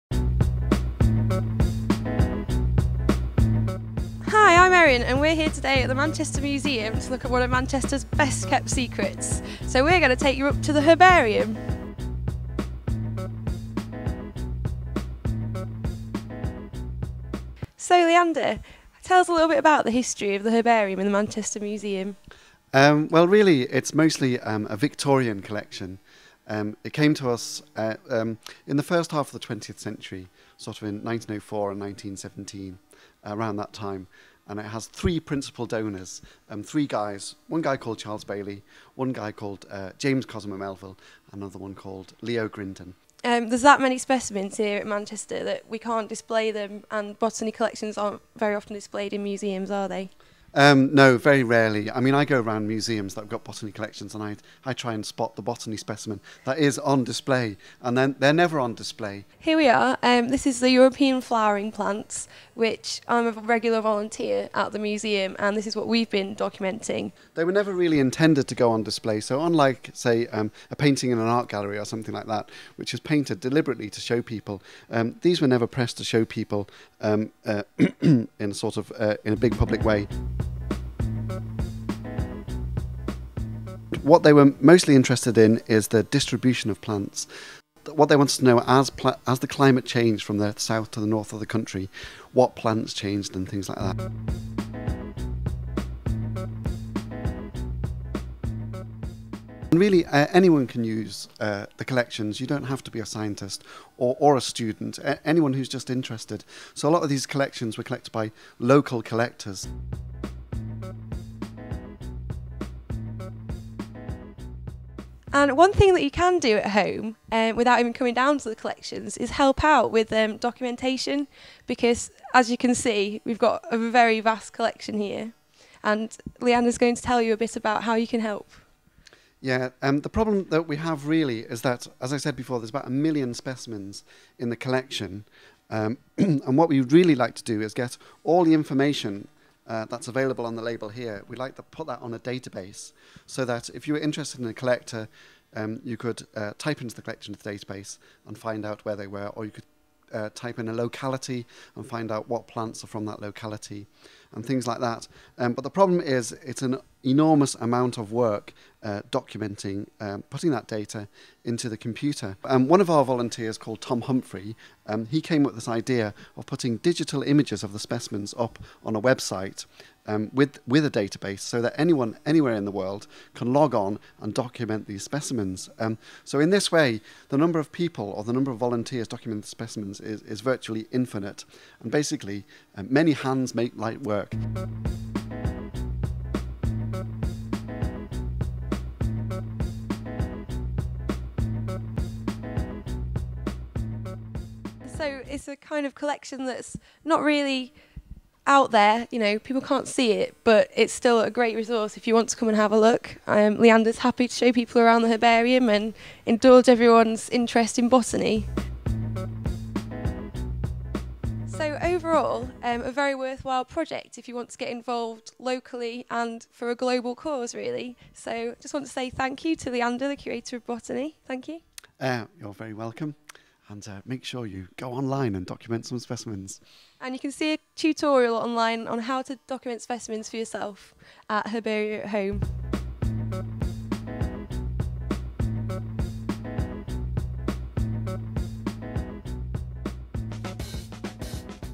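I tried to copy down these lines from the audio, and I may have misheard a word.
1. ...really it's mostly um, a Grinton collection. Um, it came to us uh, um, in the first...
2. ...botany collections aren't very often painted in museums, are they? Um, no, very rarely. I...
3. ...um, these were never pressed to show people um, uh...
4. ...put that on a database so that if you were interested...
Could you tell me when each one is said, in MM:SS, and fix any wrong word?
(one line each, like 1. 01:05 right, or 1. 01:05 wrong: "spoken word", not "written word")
1. 00:23 wrong: "Victorian", not "Grinton"
2. 00:47 wrong: "displayed", not "painted"
3. 01:14 right
4. 02:21 right.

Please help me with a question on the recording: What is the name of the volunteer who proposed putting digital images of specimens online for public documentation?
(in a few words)
Tom Humphrey.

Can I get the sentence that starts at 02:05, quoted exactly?
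And is going to tell you a bit about how you can help.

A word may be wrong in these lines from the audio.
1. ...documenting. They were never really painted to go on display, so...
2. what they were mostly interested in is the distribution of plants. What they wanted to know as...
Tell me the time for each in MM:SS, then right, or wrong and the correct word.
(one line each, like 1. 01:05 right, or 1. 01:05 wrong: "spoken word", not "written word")
1. 01:06 wrong: "intended", not "painted"
2. 01:24 right.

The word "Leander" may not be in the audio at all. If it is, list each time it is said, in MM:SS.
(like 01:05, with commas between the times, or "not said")
00:18, 03:23, 03:39.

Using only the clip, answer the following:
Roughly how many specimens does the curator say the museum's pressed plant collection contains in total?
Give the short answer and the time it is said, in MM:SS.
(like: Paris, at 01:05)
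1 million, at 02:12.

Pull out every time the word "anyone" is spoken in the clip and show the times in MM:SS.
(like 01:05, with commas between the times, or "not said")
01:40, 01:45, 02:51.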